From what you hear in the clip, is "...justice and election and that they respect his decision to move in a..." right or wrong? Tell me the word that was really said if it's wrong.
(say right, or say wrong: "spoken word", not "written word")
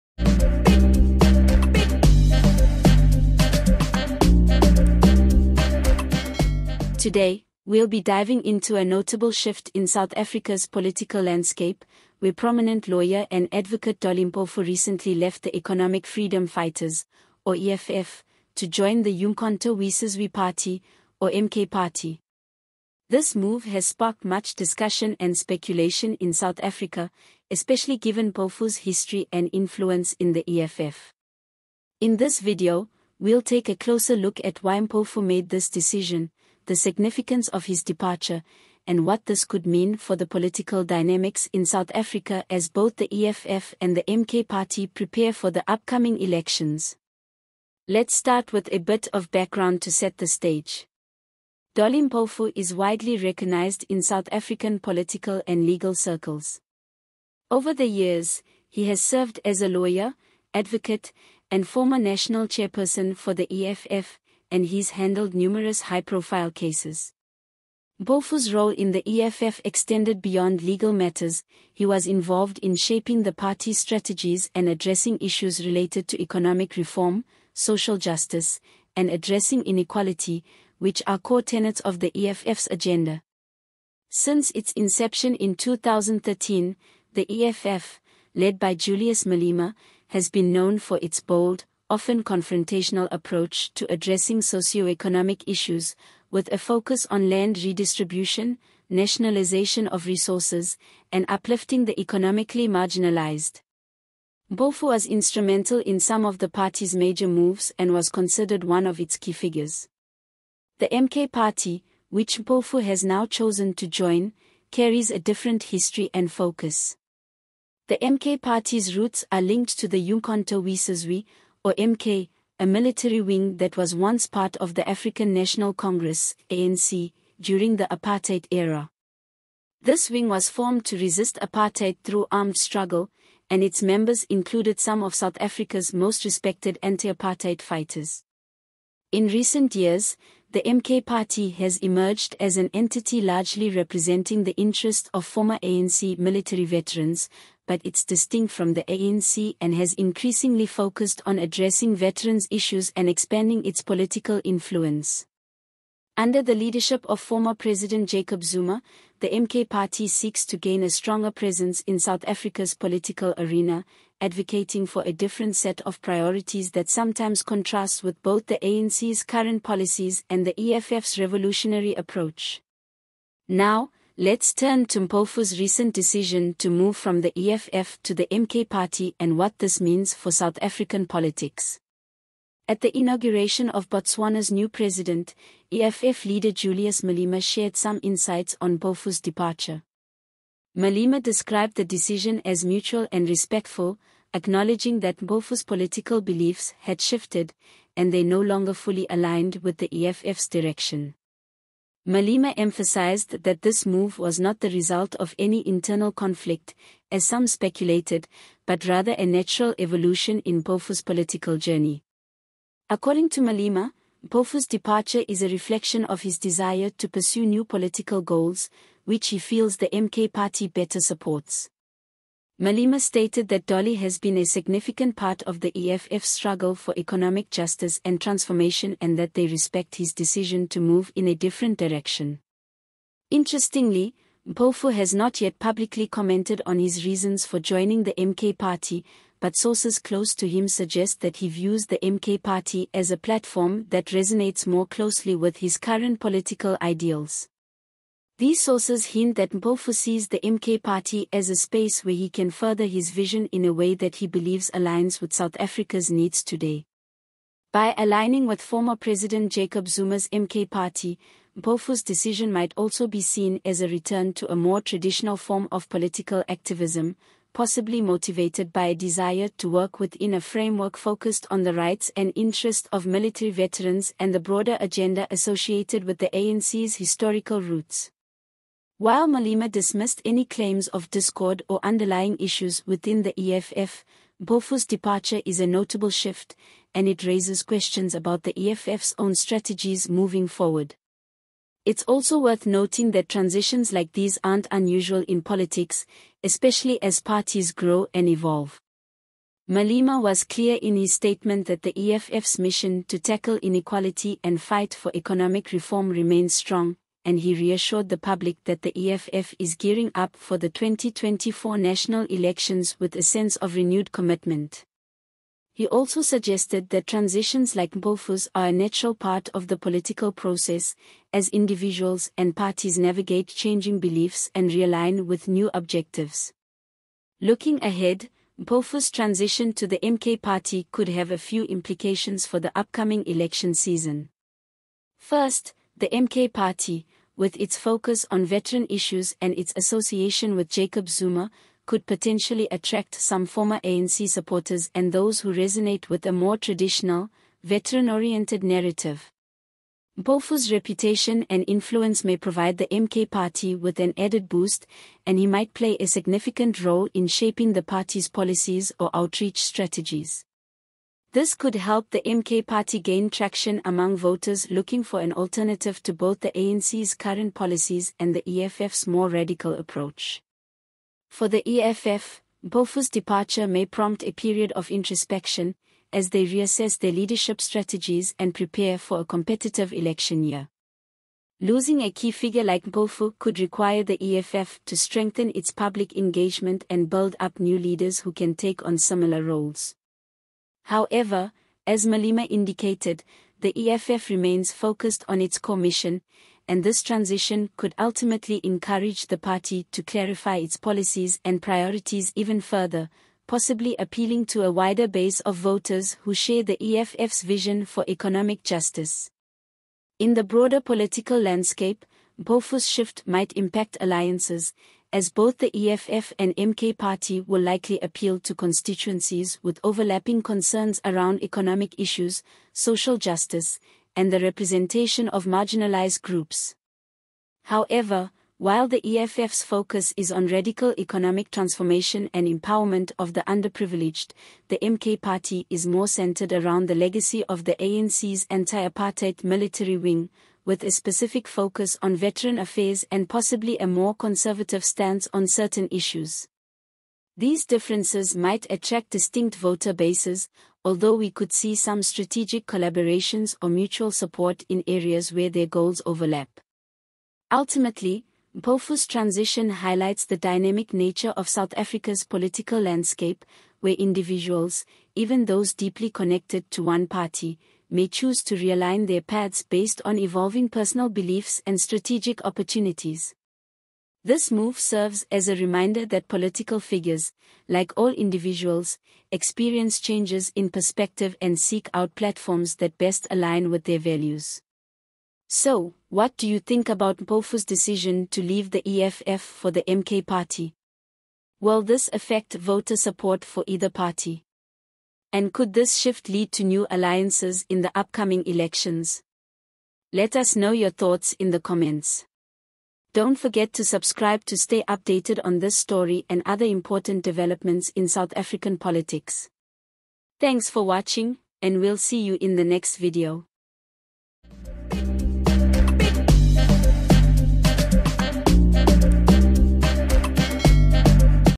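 wrong: "transformation", not "election".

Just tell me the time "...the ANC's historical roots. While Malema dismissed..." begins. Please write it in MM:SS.
04:36.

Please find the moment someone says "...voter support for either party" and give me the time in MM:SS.
08:12.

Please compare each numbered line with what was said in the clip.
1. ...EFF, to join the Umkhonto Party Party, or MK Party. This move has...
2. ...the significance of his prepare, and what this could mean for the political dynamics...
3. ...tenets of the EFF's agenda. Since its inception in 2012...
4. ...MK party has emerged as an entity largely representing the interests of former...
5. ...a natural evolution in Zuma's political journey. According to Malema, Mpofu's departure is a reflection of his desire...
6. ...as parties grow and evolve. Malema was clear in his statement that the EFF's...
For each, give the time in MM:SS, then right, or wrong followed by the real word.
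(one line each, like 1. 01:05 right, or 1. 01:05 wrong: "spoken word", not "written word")
1. 00:17 wrong: "Wesizwe", not "Party"
2. 00:36 wrong: "departure", not "prepare"
3. 01:21 wrong: "2013", not "2012"
4. 02:20 right
5. 03:29 wrong: "Mpofu", not "Zuma"
6. 04:57 right.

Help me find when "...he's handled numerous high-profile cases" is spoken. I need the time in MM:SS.
01:04.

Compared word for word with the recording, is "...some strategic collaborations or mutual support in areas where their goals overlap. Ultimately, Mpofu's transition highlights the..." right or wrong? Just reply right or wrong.
right.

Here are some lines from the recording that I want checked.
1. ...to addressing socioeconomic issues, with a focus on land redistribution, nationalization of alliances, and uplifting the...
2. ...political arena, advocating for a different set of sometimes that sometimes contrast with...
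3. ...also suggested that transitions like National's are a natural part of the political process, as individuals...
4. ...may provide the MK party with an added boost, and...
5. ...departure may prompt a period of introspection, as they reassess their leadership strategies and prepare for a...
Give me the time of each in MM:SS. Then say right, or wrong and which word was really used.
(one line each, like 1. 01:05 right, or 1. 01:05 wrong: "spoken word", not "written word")
1. 01:33 wrong: "resources", not "alliances"
2. 02:42 wrong: "priorities", not "sometimes"
3. 05:15 wrong: "Mpofu", not "National"
4. 05:52 right
5. 06:13 right.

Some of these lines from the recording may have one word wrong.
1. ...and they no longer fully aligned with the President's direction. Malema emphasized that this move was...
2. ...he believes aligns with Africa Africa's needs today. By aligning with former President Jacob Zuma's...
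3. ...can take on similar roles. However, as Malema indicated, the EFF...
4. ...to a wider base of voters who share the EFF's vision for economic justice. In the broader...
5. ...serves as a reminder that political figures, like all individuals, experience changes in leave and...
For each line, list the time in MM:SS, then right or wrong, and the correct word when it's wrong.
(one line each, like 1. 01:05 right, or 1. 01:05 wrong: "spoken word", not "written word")
1. 03:17 wrong: "EFF", not "President"
2. 04:14 wrong: "South", not "Africa"
3. 06:28 right
4. 06:44 right
5. 07:54 wrong: "perspective", not "leave".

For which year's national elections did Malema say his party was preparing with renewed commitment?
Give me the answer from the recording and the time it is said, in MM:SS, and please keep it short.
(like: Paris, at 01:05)
2024, at 05:10.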